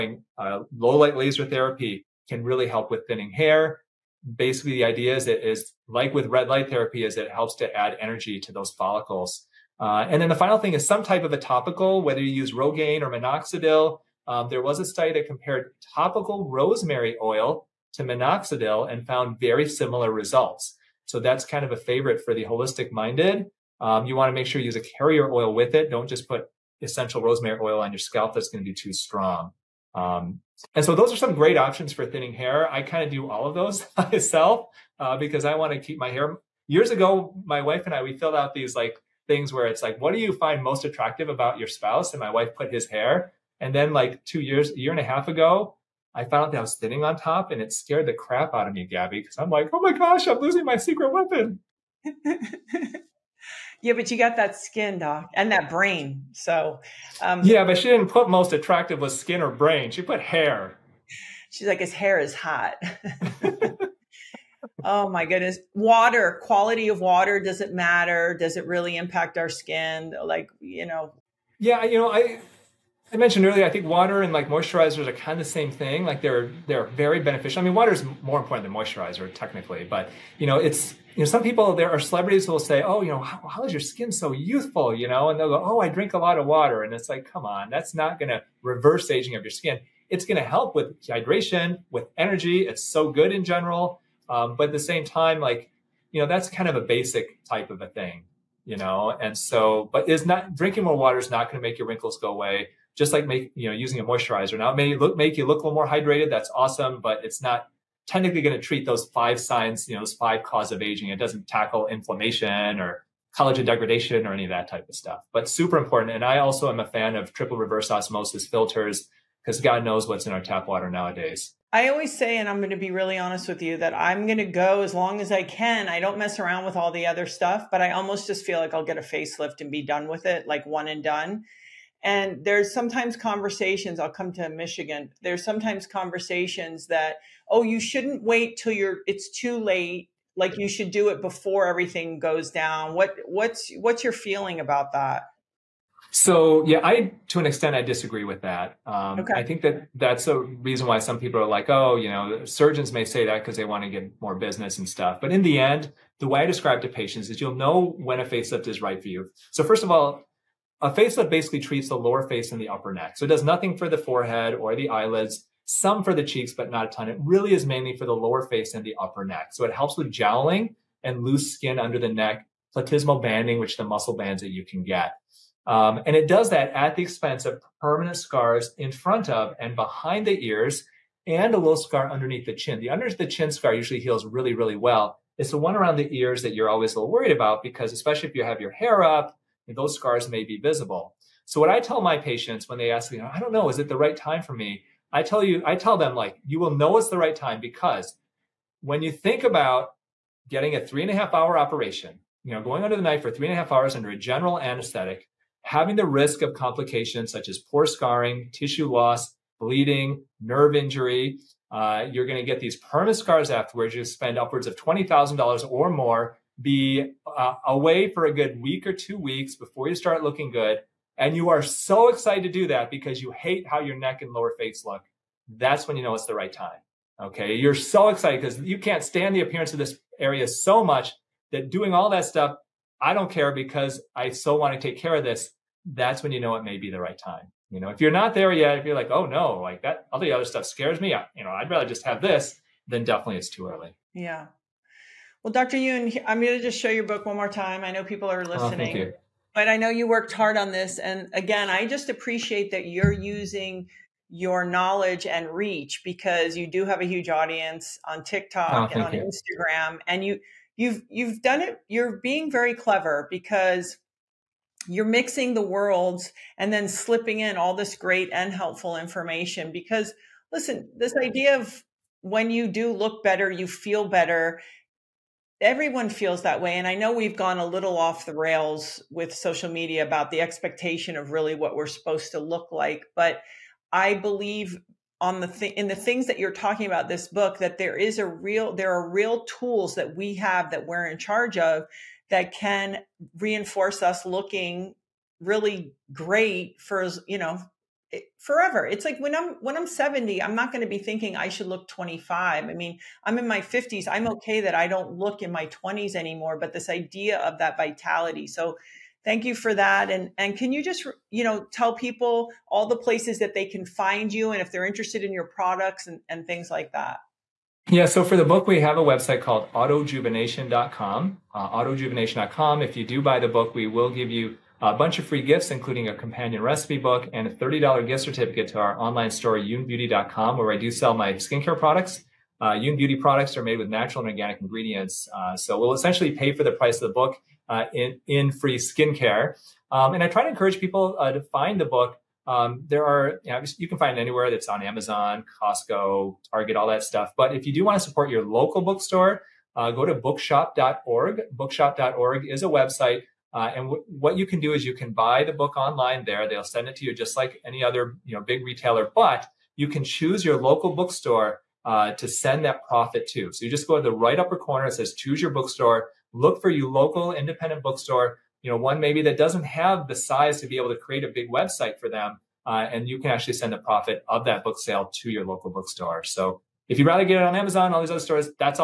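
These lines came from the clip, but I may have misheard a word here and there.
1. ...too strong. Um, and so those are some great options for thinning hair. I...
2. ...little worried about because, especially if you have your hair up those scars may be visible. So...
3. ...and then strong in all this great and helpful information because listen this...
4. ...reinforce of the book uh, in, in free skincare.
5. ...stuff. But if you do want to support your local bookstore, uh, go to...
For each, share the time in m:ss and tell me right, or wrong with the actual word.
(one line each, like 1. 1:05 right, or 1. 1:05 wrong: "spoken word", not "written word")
1. 0:28 right
2. 3:06 right
3. 4:26 wrong: "slipping", not "strong"
4. 5:36 wrong: "price", not "reinforce"
5. 5:47 right.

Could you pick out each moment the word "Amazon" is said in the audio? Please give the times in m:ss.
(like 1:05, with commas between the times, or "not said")
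5:44, 6:17.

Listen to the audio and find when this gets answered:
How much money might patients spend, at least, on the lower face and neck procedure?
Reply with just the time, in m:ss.
3:34.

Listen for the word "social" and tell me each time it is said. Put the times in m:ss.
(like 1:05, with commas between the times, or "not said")
4:39.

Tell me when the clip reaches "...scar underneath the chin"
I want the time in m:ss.
3:01.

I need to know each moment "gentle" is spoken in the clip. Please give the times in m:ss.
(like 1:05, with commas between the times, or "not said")
not said.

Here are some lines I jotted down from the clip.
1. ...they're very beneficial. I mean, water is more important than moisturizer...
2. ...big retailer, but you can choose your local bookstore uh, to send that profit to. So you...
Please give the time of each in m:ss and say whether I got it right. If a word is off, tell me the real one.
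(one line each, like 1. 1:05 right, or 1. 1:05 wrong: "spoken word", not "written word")
1. 1:16 right
2. 5:58 right.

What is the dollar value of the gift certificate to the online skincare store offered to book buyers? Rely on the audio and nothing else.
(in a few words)
$30.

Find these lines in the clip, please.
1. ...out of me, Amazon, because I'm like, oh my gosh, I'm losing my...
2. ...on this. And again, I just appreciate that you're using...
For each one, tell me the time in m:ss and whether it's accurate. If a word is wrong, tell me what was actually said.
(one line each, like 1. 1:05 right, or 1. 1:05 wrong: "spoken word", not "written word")
1. 0:48 wrong: "Gabby", not "Amazon"
2. 4:10 right.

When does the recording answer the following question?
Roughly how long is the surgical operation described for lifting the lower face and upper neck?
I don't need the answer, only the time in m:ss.
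3:20.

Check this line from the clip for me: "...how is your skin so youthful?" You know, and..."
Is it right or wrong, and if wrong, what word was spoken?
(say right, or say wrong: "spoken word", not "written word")
right.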